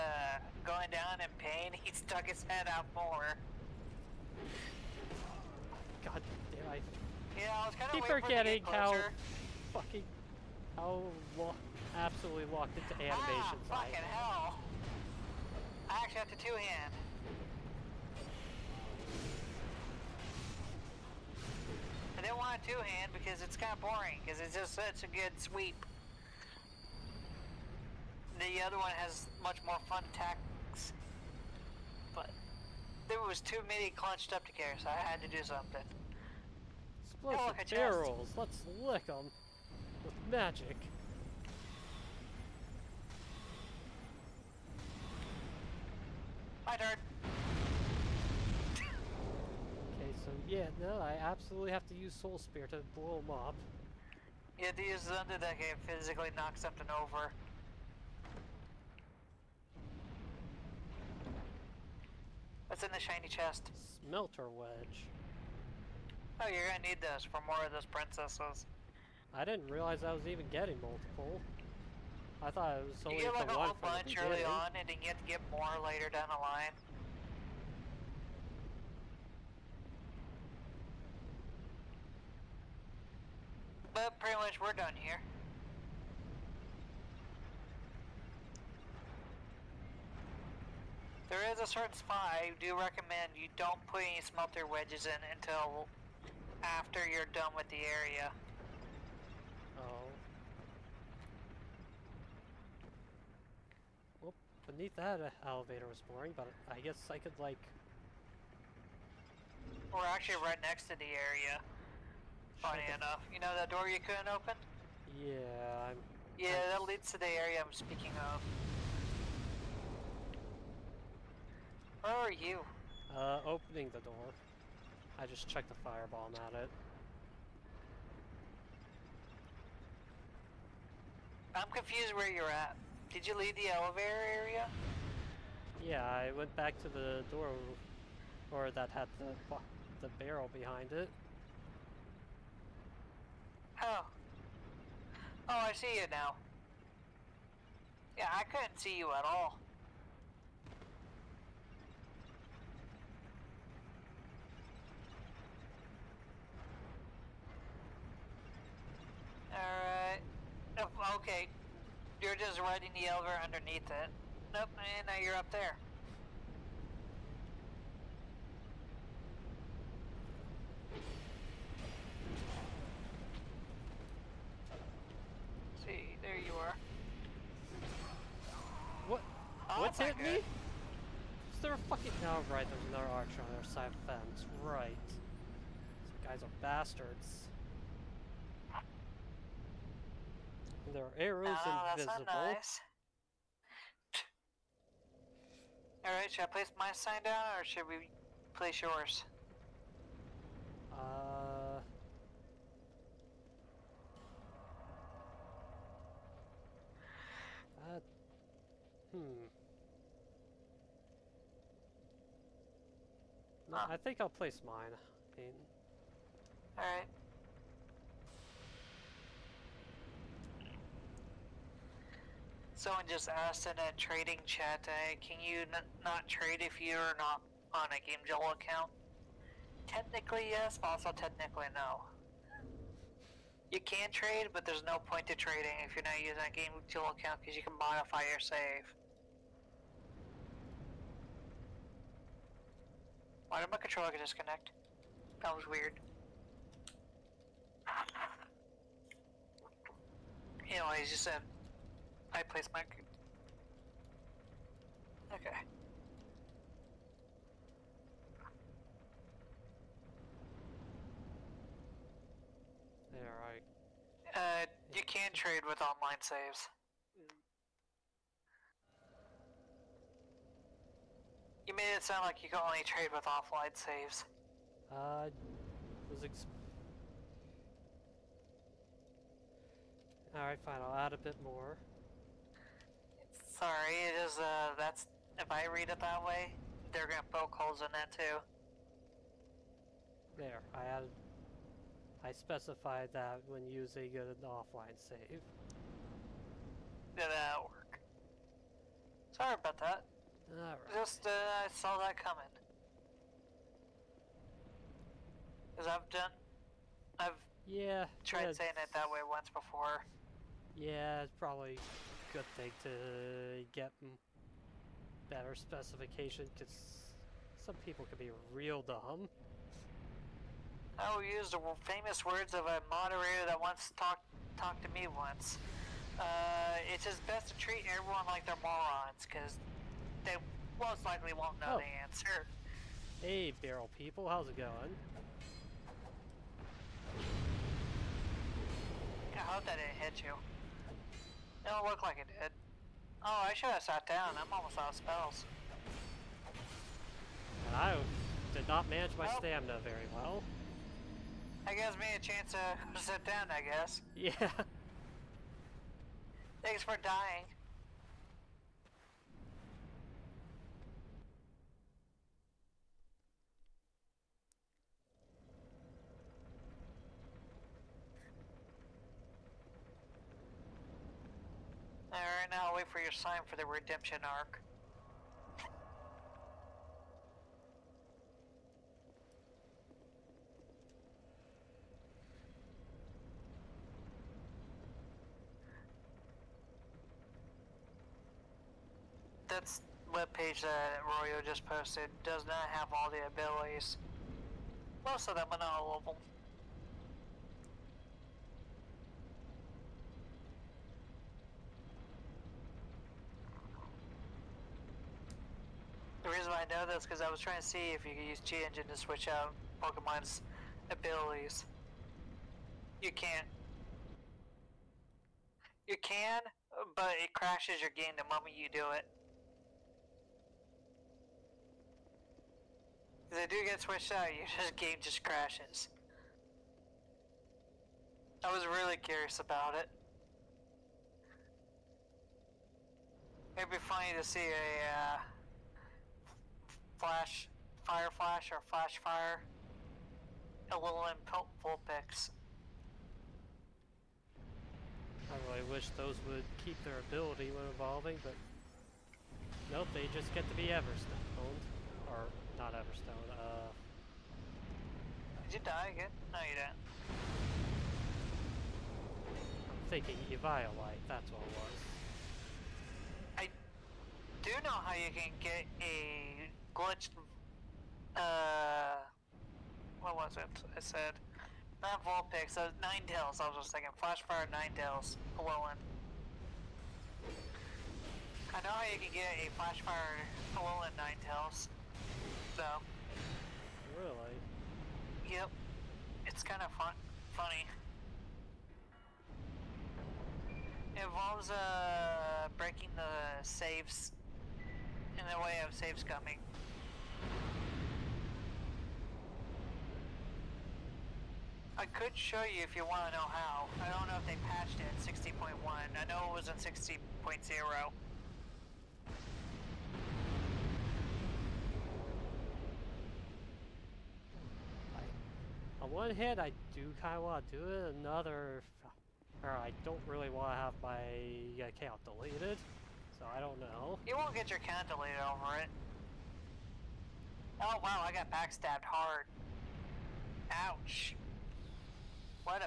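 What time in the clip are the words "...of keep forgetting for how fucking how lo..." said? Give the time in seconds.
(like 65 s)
7 s.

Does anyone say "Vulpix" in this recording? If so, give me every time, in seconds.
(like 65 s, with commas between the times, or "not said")
441 s, 472 s.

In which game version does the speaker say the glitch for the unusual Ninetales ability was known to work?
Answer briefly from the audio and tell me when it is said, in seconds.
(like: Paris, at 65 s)
60.0, at 506 s.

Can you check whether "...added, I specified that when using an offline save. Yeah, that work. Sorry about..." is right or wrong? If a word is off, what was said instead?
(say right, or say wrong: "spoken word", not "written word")
right.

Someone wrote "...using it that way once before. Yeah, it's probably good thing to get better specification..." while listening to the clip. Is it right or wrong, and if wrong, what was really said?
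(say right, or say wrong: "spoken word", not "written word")
wrong: "saying", not "using".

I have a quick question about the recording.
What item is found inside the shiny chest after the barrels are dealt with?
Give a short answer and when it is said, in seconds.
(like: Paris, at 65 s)
Smelter wedge, at 63 s.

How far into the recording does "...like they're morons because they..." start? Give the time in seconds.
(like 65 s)
328 s.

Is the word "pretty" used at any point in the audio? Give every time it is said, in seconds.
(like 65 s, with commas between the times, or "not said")
84 s.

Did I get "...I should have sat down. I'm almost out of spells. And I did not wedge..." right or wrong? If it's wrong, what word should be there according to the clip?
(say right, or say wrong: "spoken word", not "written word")
wrong: "manage", not "wedge".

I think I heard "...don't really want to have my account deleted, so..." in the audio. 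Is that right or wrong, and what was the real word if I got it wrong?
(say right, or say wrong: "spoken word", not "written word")
right.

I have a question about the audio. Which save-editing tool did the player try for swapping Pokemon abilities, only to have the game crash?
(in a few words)
G-Engine.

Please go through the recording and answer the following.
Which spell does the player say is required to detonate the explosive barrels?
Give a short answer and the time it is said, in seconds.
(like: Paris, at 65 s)
Soul Spear, at 52 s.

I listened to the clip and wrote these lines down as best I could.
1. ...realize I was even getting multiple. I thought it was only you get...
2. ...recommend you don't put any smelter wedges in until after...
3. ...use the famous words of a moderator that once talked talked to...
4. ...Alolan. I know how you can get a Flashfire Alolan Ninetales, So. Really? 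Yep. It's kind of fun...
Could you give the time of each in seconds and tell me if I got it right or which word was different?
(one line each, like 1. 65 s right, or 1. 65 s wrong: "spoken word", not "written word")
1. 69 s right
2. 92 s right
3. 321 s right
4. 475 s right.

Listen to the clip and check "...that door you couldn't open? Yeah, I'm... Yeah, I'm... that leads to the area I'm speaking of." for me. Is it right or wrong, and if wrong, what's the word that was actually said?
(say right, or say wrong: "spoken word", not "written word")
right.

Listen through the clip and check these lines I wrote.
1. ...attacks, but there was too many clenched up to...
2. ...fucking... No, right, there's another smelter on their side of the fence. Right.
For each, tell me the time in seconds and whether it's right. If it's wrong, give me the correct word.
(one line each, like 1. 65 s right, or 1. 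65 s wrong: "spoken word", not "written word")
1. 30 s right
2. 181 s wrong: "archer", not "smelter".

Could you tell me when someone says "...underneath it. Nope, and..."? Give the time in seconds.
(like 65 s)
163 s.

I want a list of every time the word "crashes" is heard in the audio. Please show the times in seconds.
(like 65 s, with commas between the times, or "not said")
417 s, 425 s.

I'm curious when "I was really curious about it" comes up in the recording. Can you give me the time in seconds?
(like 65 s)
428 s.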